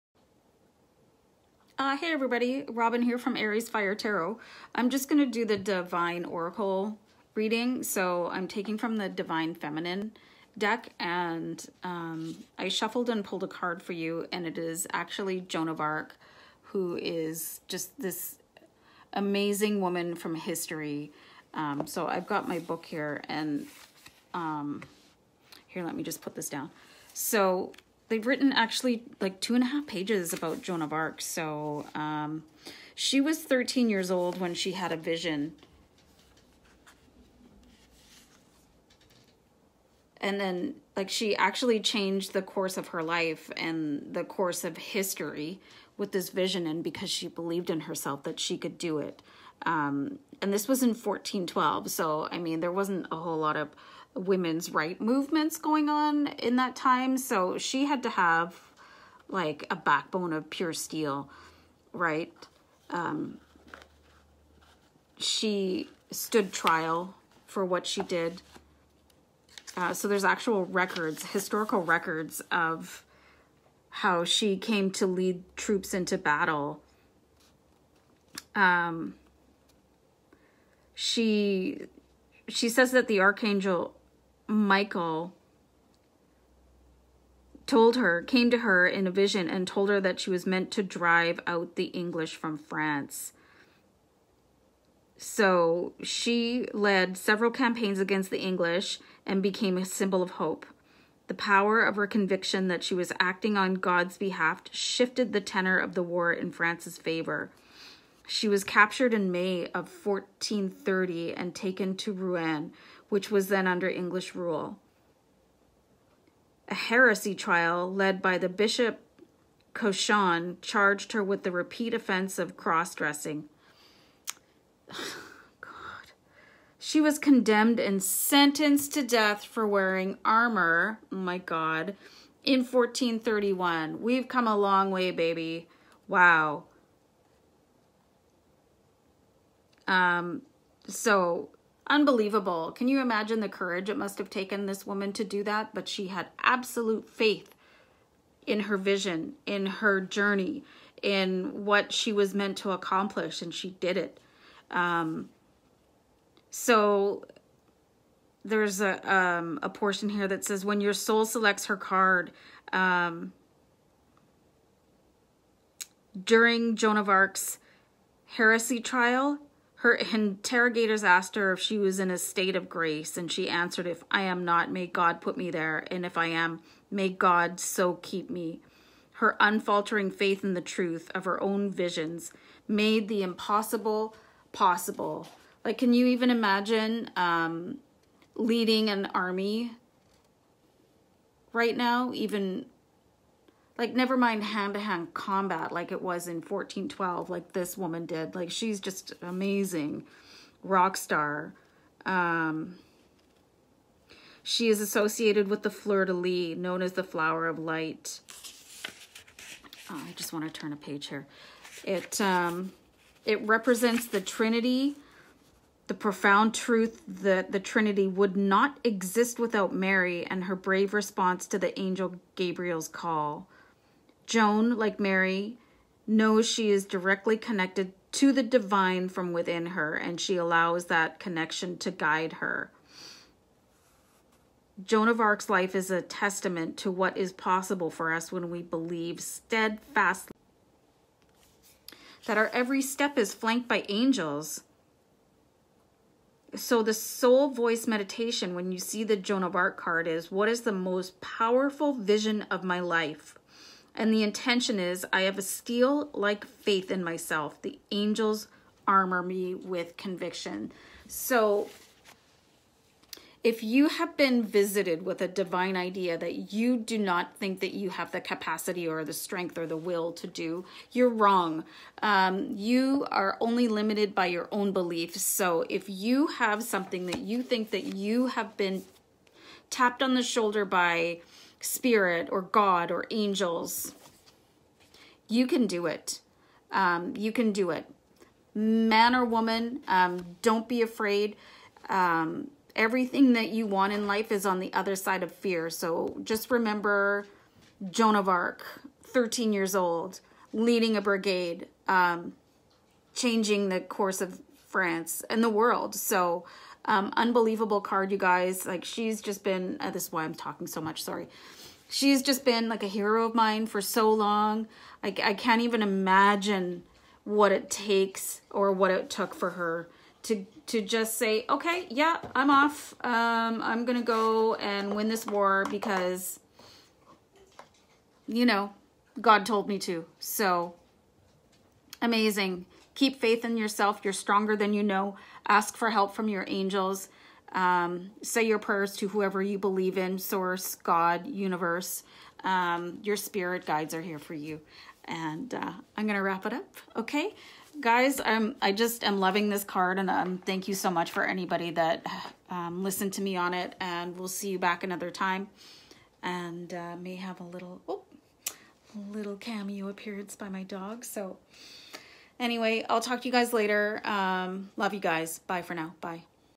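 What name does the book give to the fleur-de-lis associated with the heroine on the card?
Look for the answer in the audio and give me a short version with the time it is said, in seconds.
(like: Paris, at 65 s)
flower of light, at 207 s.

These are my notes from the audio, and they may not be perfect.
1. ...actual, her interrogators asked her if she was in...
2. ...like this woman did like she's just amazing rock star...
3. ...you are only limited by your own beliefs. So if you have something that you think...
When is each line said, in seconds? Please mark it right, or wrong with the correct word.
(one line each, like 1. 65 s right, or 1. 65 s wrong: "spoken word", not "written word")
1. 168 s wrong: "trial", not "actual"
2. 197 s right
3. 272 s right.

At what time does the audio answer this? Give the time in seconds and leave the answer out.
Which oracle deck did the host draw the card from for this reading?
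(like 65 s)
9 s.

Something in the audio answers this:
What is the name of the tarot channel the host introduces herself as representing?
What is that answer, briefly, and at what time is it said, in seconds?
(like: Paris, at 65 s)
Aries Fire Tarot, at 3 s.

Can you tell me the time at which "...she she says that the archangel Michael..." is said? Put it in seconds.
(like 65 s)
80 s.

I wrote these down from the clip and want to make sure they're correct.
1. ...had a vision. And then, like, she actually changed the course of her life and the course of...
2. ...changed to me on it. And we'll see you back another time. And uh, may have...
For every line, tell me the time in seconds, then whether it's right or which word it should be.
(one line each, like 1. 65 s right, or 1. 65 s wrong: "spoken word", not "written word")
1. 34 s right
2. 352 s wrong: "listened", not "changed".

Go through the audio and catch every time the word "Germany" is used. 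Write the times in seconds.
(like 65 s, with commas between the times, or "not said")
not said.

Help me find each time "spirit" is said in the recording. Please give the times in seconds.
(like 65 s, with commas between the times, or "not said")
281 s, 343 s.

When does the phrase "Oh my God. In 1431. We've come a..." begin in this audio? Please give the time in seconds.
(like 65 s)
131 s.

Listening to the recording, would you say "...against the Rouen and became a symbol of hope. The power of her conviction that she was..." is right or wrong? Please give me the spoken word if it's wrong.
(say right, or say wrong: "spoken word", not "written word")
wrong: "English", not "Rouen".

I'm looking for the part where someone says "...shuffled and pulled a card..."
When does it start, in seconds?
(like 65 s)
12 s.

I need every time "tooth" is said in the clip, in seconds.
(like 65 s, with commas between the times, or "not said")
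not said.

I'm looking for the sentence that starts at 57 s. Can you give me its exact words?
So she had to have like a backbone of pure steel, right?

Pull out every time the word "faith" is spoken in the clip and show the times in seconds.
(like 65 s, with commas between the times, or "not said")
147 s, 180 s, 256 s, 333 s.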